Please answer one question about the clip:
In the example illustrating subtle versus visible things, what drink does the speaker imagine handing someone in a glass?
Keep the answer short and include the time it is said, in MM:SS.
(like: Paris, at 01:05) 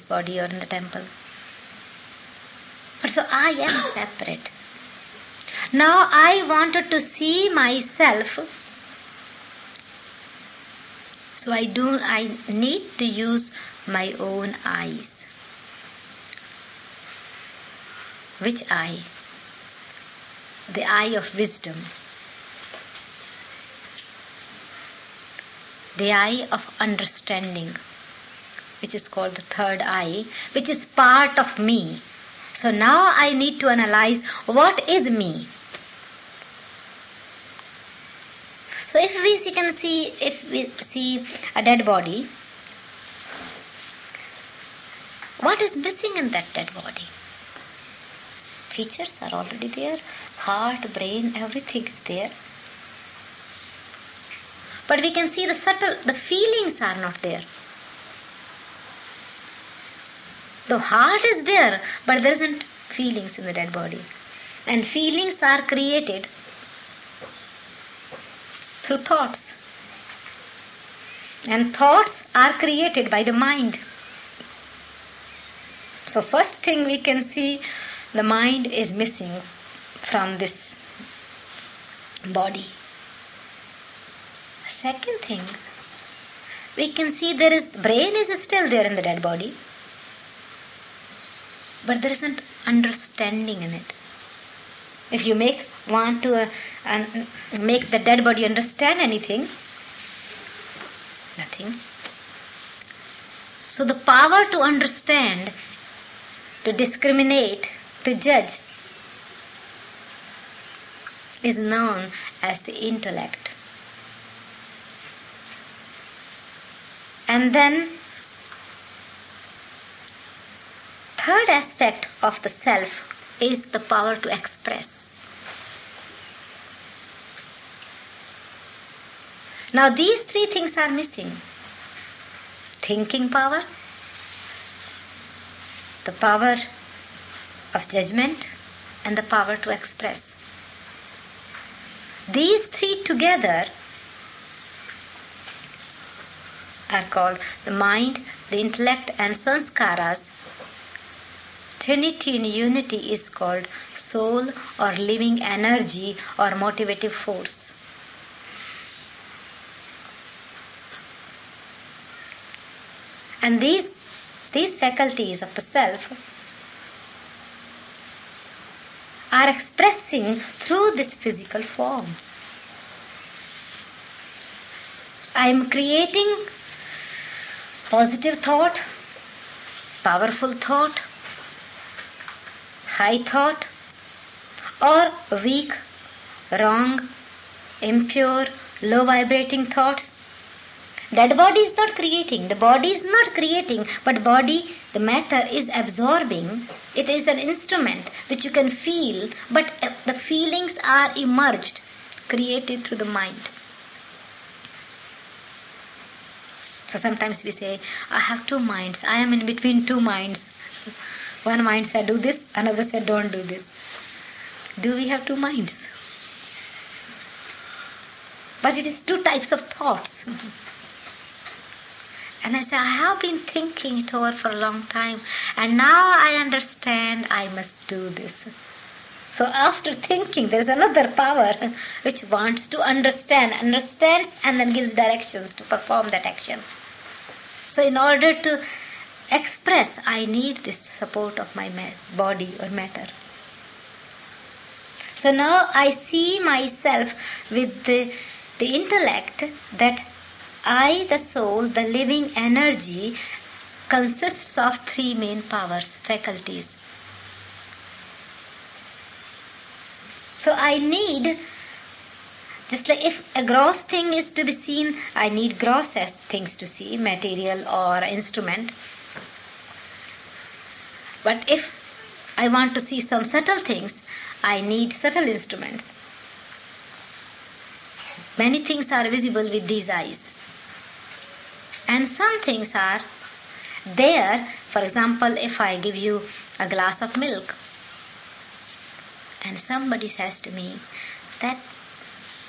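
milk, at 04:47.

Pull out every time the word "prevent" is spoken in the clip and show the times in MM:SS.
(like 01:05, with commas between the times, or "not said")
not said.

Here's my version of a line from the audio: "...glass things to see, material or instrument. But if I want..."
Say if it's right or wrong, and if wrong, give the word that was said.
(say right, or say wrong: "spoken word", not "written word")
wrong: "gross", not "glass".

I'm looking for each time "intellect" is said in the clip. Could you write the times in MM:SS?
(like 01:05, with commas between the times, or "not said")
01:52, 02:28, 04:08.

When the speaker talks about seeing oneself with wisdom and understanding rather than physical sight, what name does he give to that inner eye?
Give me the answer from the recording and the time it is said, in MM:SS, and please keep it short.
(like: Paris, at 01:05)
third eye, at 00:29.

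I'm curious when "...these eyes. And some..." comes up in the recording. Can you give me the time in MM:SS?
04:39.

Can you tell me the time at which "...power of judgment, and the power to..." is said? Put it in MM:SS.
02:16.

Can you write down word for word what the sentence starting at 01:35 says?
If you make want to uh, make the dead body understand anything, nothing.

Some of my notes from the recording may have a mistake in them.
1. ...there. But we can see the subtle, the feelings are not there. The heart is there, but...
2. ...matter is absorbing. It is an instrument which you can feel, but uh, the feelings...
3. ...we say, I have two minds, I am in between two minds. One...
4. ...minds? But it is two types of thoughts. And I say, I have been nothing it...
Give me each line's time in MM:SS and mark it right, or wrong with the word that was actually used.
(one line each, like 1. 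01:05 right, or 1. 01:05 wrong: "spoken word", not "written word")
1. 00:51 right
2. 03:14 right
3. 03:27 right
4. 03:35 wrong: "thinking", not "nothing".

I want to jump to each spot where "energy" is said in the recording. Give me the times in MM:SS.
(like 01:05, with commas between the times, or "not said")
02:35, 04:12.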